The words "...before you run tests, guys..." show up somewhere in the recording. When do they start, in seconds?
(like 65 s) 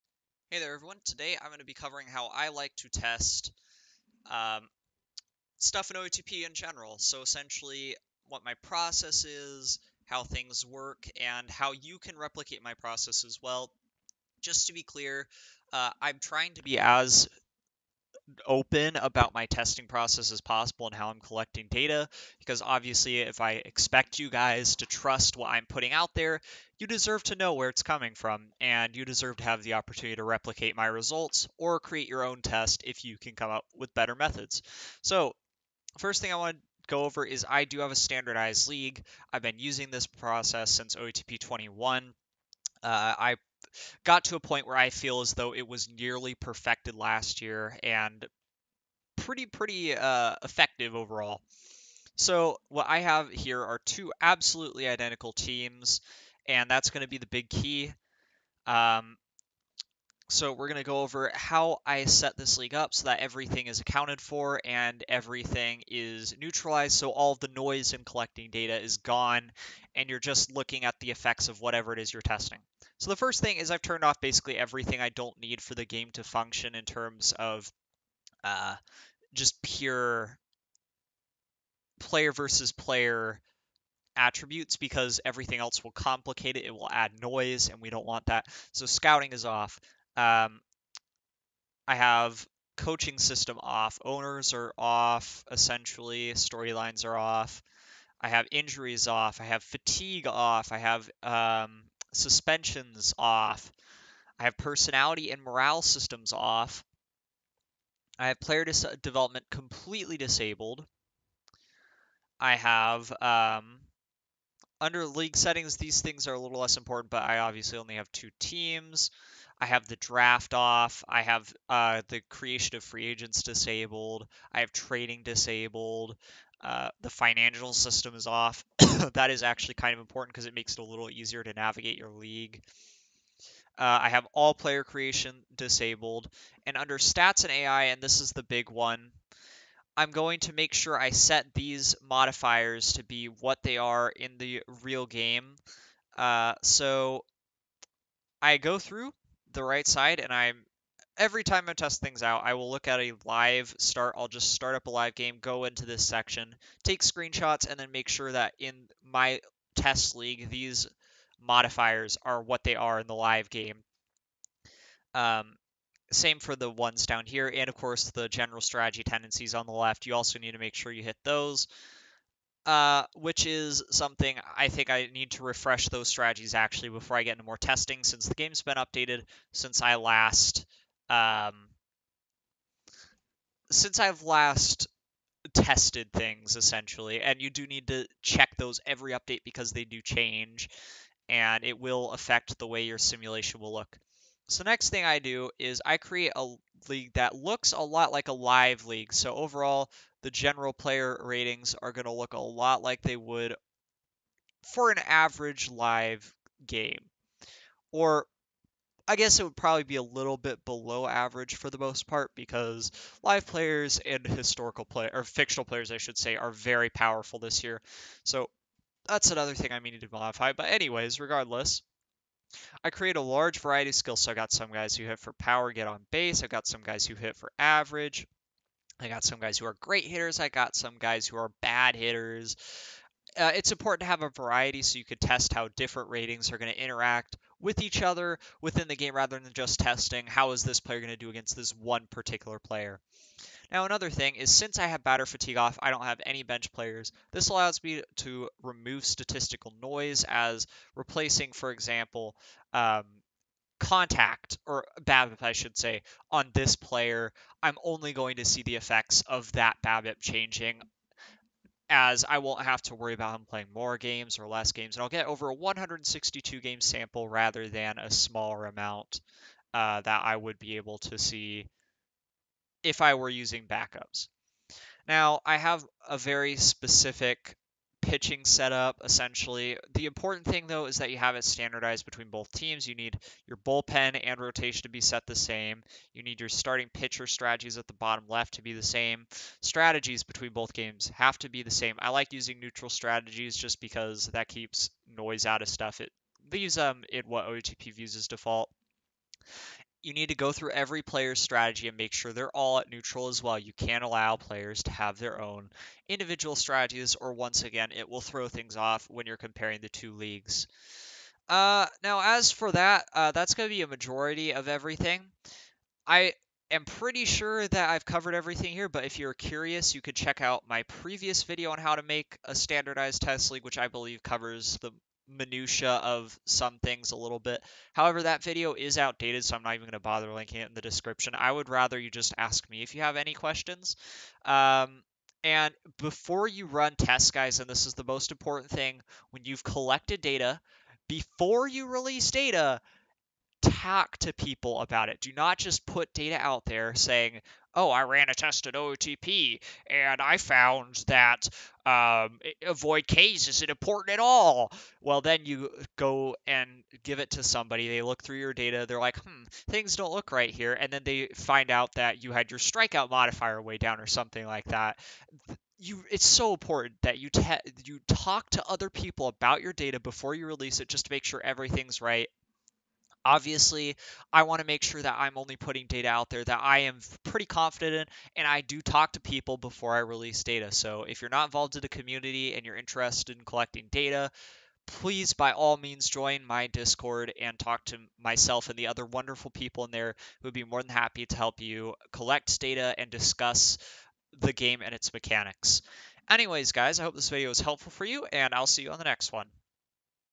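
335 s.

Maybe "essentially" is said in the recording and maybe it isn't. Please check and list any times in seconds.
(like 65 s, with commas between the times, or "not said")
7 s, 95 s, 186 s, 279 s.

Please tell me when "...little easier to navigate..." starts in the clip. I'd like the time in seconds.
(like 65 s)
130 s.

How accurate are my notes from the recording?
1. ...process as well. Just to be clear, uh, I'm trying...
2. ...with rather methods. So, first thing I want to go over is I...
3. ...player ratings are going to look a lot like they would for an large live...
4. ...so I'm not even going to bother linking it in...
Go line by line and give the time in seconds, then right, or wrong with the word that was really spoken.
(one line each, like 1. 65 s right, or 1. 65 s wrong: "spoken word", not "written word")
1. 12 s right
2. 33 s wrong: "better", not "rather"
3. 200 s wrong: "average", not "large"
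4. 329 s right.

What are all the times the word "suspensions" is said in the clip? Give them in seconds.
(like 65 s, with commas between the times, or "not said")
102 s.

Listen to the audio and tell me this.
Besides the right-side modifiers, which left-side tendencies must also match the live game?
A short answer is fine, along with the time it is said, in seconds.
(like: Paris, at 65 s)
general strategy tendencies, at 168 s.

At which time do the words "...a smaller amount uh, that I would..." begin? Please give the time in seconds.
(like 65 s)
267 s.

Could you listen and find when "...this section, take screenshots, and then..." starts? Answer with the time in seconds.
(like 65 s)
155 s.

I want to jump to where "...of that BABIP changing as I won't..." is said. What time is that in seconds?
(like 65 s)
259 s.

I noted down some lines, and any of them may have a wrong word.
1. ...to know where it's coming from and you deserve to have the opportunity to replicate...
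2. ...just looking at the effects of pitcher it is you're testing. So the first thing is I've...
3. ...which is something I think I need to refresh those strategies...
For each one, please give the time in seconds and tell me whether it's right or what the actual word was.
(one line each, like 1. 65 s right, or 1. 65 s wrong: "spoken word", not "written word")
1. 27 s right
2. 70 s wrong: "whatever", not "pitcher"
3. 173 s right.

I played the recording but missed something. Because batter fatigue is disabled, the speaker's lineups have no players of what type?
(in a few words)
bench players.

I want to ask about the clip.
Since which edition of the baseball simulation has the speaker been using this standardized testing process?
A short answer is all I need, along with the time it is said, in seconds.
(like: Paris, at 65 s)
OOTP 21, at 40 s.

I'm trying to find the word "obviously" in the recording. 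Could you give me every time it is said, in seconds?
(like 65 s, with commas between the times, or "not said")
22 s, 117 s, 373 s.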